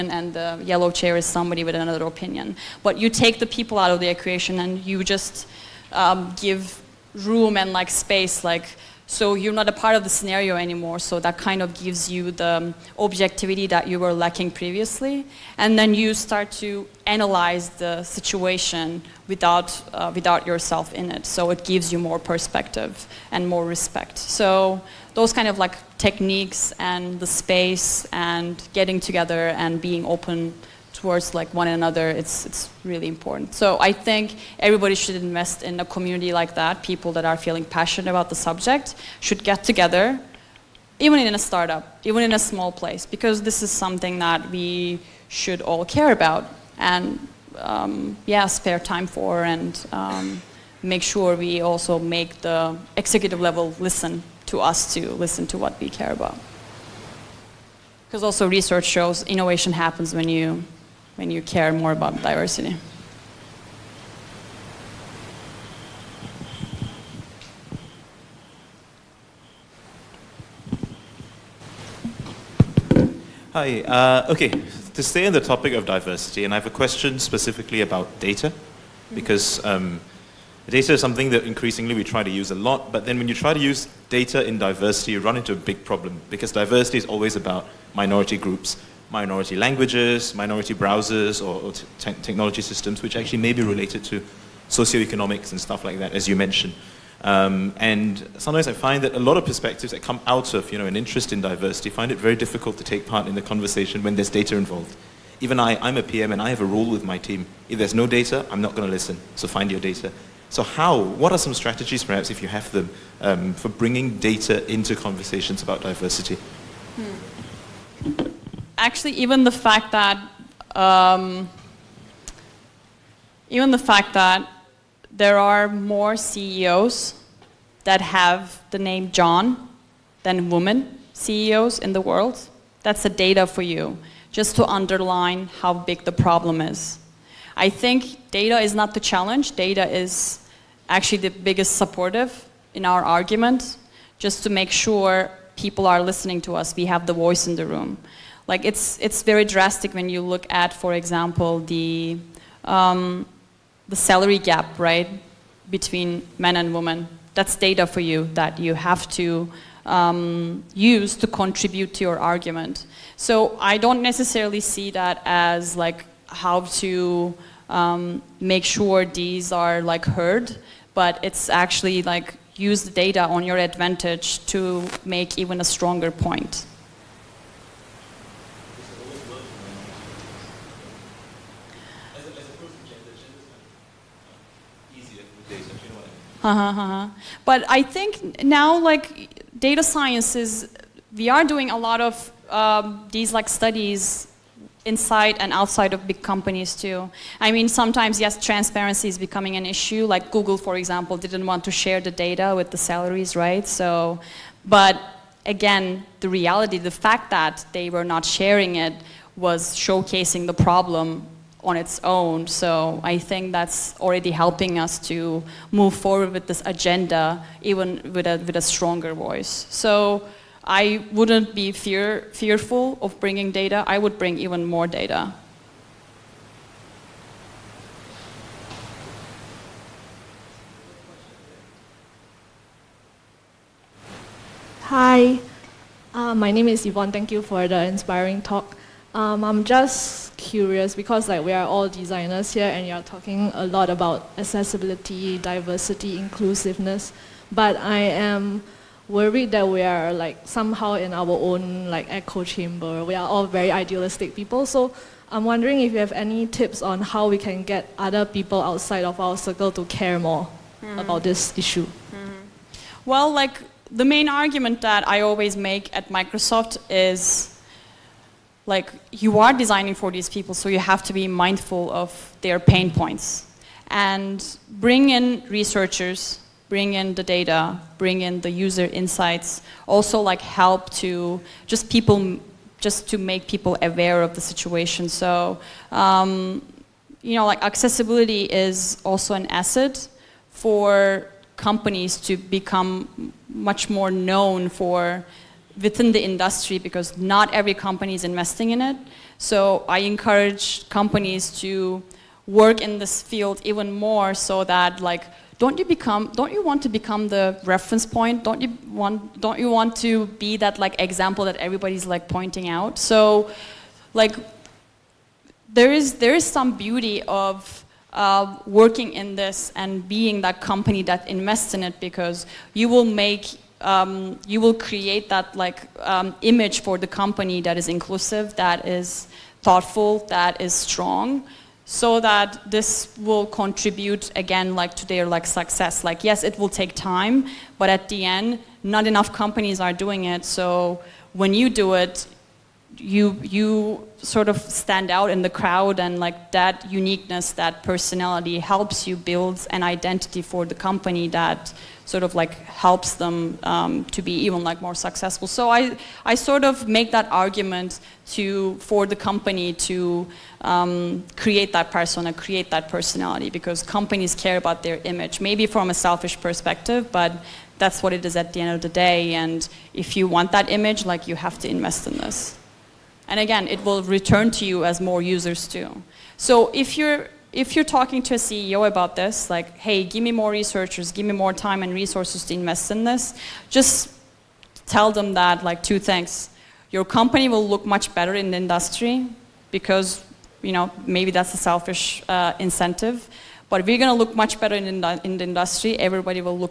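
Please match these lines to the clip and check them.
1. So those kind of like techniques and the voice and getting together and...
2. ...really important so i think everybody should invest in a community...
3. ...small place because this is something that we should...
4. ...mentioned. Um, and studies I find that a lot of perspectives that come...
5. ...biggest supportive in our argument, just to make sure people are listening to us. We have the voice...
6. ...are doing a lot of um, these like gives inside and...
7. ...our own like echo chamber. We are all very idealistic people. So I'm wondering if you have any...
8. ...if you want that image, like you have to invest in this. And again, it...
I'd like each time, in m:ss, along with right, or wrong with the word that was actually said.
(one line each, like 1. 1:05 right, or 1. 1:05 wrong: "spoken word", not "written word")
1. 0:24 wrong: "space", not "voice"
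2. 0:32 right
3. 0:42 right
4. 1:36 wrong: "sometimes", not "studies"
5. 2:21 right
6. 3:11 wrong: "studies", not "gives"
7. 4:11 right
8. 6:09 right.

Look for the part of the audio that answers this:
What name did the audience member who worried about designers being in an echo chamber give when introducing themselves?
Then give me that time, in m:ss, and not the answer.
3:56.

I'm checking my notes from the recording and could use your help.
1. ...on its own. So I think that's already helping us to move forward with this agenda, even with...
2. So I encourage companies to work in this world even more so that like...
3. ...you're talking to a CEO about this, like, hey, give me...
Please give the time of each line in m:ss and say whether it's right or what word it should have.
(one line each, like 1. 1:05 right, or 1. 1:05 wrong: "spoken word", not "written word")
1. 3:31 right
2. 4:59 wrong: "field", not "world"
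3. 6:17 right.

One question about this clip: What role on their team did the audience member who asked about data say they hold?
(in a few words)
PM.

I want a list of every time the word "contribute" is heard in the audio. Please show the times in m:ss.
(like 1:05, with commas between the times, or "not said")
2:41, 5:33.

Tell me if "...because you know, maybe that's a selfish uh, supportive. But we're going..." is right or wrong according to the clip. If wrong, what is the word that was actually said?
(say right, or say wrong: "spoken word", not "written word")
wrong: "incentive", not "supportive".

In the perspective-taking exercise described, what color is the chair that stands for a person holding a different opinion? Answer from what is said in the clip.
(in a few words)
Yellow.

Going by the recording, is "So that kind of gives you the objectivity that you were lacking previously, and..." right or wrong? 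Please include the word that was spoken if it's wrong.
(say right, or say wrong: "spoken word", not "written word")
right.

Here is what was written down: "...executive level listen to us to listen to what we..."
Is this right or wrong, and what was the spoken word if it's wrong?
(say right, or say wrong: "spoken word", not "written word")
right.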